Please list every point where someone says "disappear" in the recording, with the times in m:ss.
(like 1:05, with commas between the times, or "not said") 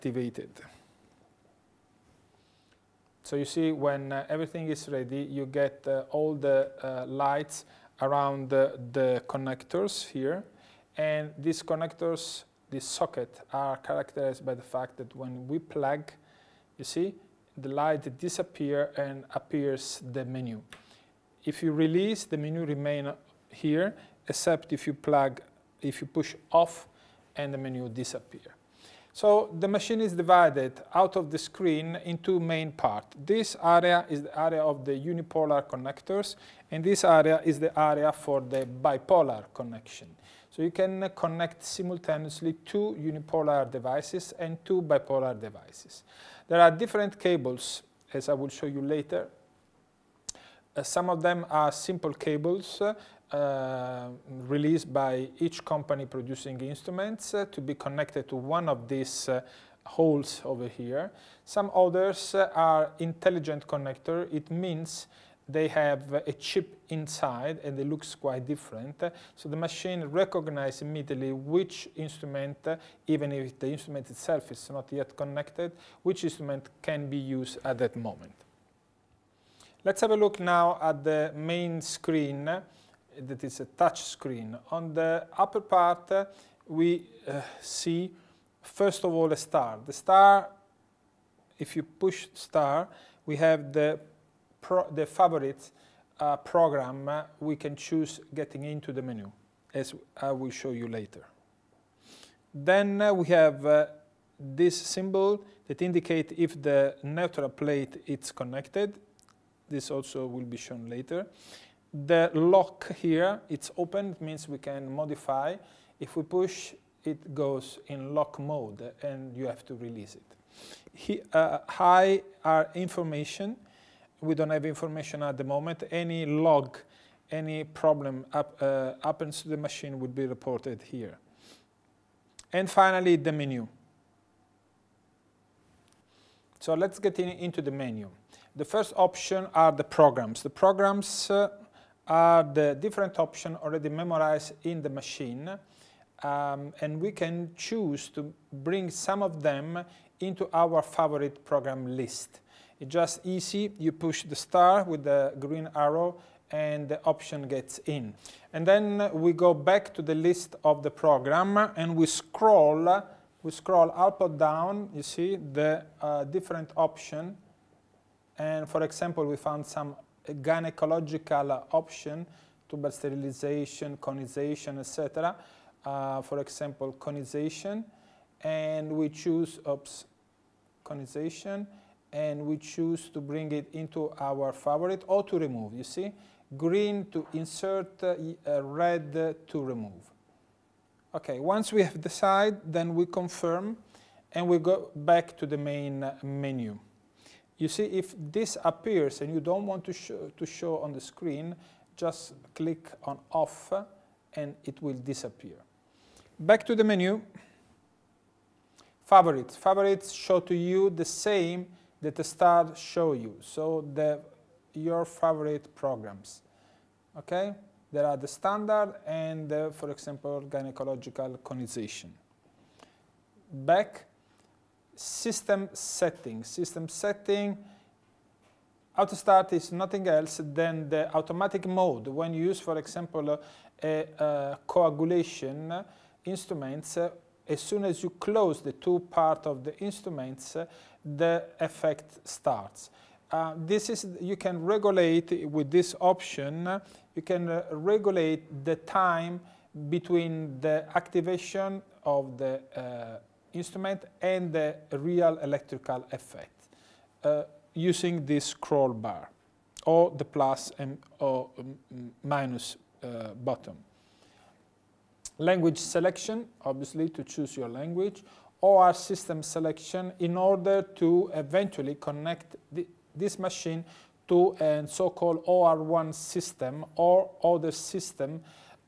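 0:18, 0:27, 3:24.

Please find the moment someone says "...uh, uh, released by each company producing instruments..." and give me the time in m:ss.
0:52.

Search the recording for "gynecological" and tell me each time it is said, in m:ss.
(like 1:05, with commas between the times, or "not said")
2:50, 3:40.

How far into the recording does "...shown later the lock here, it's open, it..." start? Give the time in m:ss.
1:50.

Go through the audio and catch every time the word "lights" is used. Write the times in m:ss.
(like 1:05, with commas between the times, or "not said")
0:07, 0:17.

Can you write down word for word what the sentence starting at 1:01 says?
Some others uh, are intelligent connector.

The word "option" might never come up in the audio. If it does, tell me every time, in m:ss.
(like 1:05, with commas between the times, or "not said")
2:18, 2:23, 2:37, 2:46, 2:51, 4:06.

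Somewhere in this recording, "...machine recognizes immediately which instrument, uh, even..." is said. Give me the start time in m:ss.
1:09.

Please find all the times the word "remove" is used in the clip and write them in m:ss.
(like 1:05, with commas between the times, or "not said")
3:05, 3:09.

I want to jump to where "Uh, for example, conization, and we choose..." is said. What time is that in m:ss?
2:55.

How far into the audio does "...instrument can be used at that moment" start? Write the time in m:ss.
1:16.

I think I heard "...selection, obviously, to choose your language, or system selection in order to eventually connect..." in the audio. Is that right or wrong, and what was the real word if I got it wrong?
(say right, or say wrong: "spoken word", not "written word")
right.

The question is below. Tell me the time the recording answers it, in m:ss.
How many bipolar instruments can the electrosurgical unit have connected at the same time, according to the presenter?
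0:44.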